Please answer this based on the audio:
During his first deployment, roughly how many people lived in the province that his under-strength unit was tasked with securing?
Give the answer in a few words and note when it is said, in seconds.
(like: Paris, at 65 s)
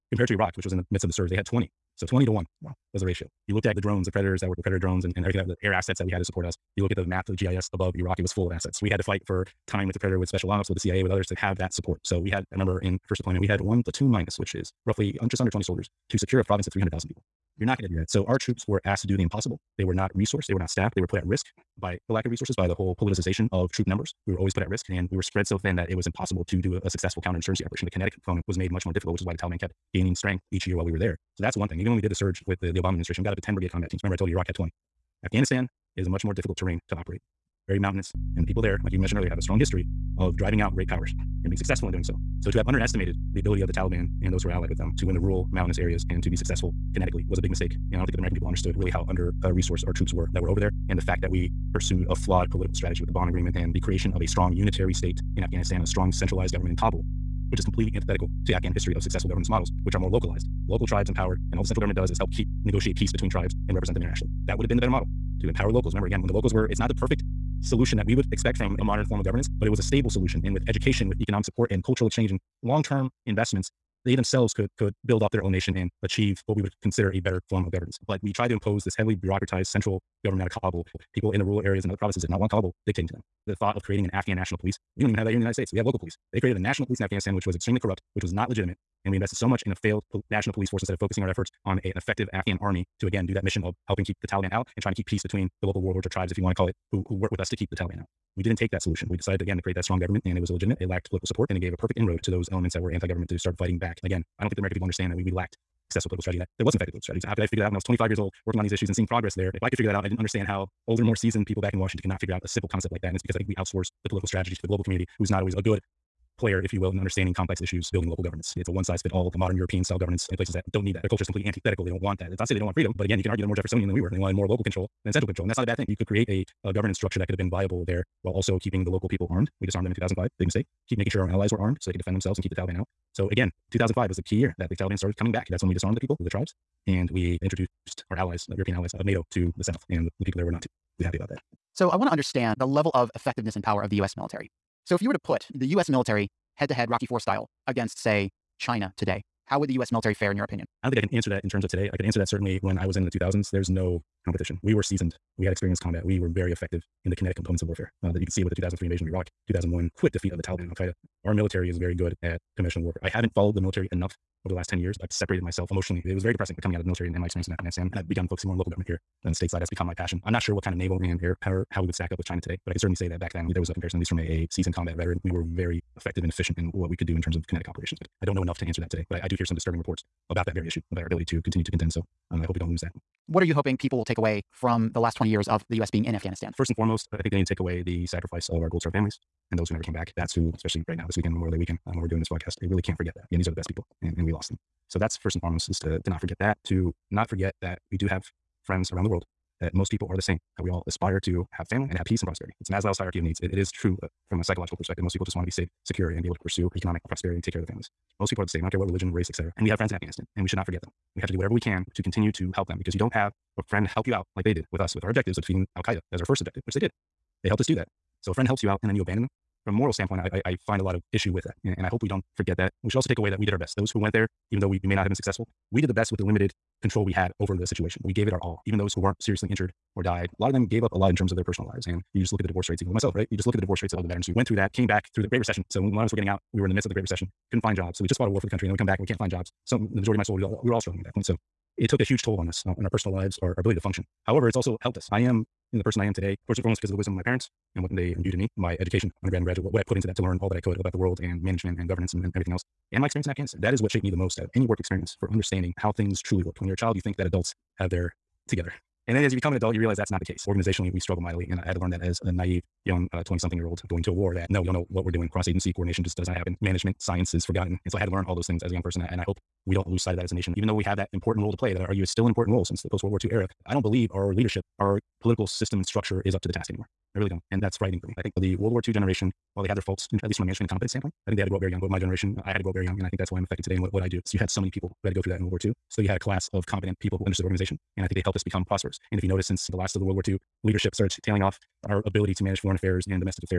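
300,000, at 16 s.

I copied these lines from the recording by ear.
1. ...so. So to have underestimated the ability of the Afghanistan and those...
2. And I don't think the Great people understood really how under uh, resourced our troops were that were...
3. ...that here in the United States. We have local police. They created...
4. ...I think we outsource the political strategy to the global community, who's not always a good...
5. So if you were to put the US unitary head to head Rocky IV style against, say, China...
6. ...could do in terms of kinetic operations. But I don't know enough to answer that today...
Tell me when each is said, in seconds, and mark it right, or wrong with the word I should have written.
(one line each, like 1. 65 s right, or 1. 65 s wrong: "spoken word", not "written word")
1. 42 s wrong: "Taliban", not "Afghanistan"
2. 47 s wrong: "American", not "Great"
3. 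85 s right
4. 113 s right
5. 144 s wrong: "military", not "unitary"
6. 176 s right.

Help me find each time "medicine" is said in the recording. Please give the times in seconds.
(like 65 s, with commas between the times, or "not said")
not said.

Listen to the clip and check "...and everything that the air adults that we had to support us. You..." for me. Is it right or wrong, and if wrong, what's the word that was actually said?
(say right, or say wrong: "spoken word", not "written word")
wrong: "assets", not "adults".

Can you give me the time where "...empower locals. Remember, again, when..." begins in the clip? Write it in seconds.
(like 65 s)
65 s.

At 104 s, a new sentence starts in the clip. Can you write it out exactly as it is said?
Again, I don't think the American people understand that we, we lacked successful political strategy that there was an effective political strategy.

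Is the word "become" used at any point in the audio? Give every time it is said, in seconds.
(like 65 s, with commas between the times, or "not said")
169 s, 259 s, 288 s.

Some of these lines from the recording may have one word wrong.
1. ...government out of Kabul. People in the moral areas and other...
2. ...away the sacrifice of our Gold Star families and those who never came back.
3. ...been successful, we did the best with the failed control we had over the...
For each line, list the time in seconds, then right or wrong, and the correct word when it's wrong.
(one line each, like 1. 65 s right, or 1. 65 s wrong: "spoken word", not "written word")
1. 80 s wrong: "rural", not "moral"
2. 187 s right
3. 225 s wrong: "limited", not "failed".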